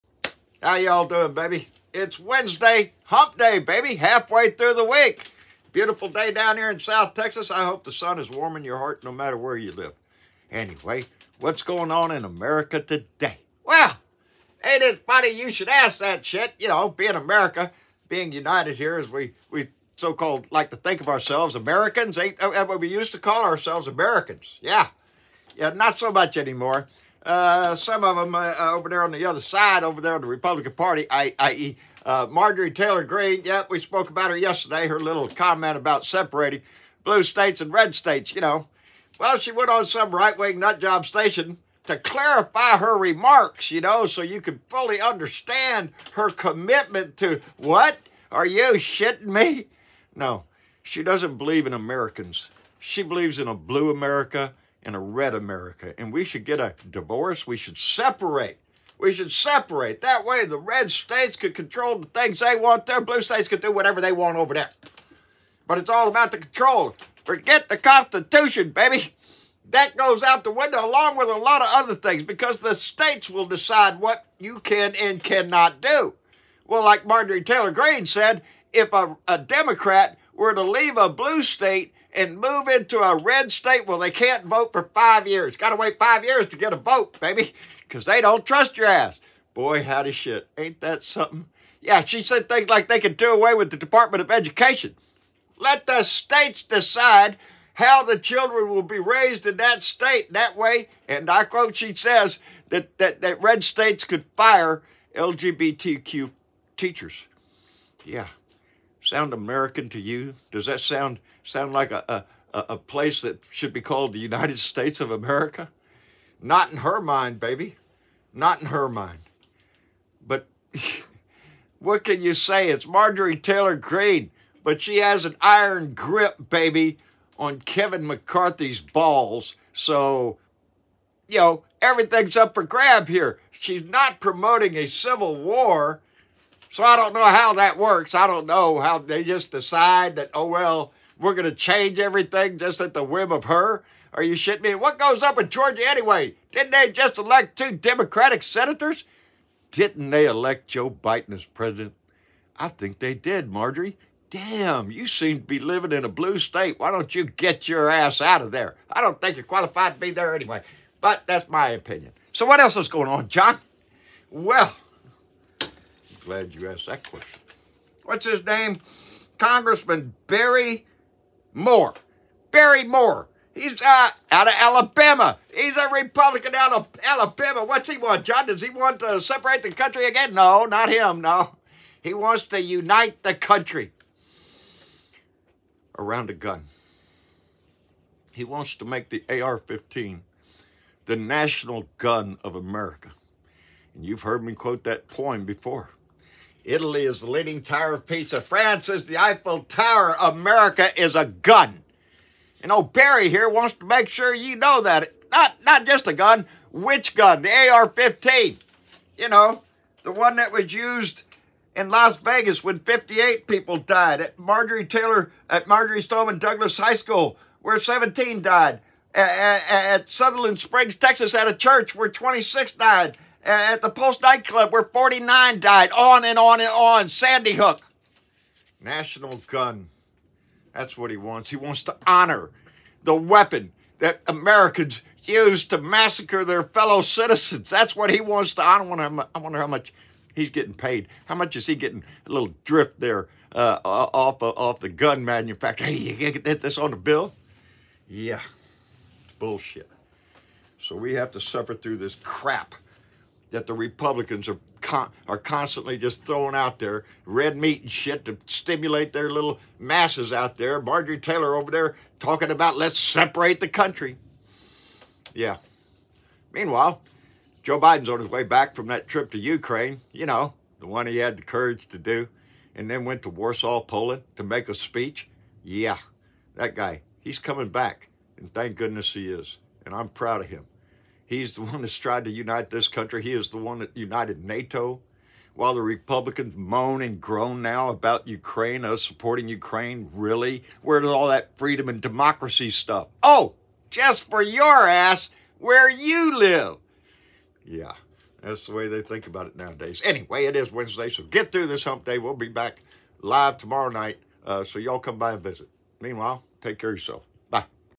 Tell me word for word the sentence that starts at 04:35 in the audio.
Yeah, that guy, he's coming back, and thank goodness he is.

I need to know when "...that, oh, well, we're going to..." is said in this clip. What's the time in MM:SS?
02:20.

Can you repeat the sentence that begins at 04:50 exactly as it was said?
Where does all that freedom and democracy stuff?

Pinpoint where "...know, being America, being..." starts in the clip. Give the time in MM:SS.
00:16.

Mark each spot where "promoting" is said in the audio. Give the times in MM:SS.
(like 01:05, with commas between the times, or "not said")
02:14.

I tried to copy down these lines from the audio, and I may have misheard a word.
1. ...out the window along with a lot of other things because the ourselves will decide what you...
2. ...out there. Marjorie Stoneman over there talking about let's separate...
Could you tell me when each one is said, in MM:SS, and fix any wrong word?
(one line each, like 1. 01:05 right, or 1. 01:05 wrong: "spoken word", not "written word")
1. 01:10 wrong: "states", not "ourselves"
2. 04:20 wrong: "Taylor", not "Stoneman".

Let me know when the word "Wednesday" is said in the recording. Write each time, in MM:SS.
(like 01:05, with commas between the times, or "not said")
00:02, 05:00.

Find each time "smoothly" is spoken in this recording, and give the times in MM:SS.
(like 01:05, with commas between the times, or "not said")
not said.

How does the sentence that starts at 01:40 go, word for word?
That way, and I quote, she says that, that, that red states could fire LGBTQ teachers.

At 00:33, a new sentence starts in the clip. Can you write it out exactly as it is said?
Yep, we spoke about her yesterday, her little comment about separating blue states and red states, you know.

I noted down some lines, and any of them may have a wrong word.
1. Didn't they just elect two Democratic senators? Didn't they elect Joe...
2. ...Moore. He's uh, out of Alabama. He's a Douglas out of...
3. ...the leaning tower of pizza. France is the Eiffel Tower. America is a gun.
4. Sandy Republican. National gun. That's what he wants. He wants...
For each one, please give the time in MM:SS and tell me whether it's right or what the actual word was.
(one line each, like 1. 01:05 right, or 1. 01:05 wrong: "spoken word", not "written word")
1. 02:26 right
2. 02:52 wrong: "Republican", not "Douglas"
3. 03:17 right
4. 03:47 wrong: "Hook", not "Republican".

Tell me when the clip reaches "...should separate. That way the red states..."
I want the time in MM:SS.
00:59.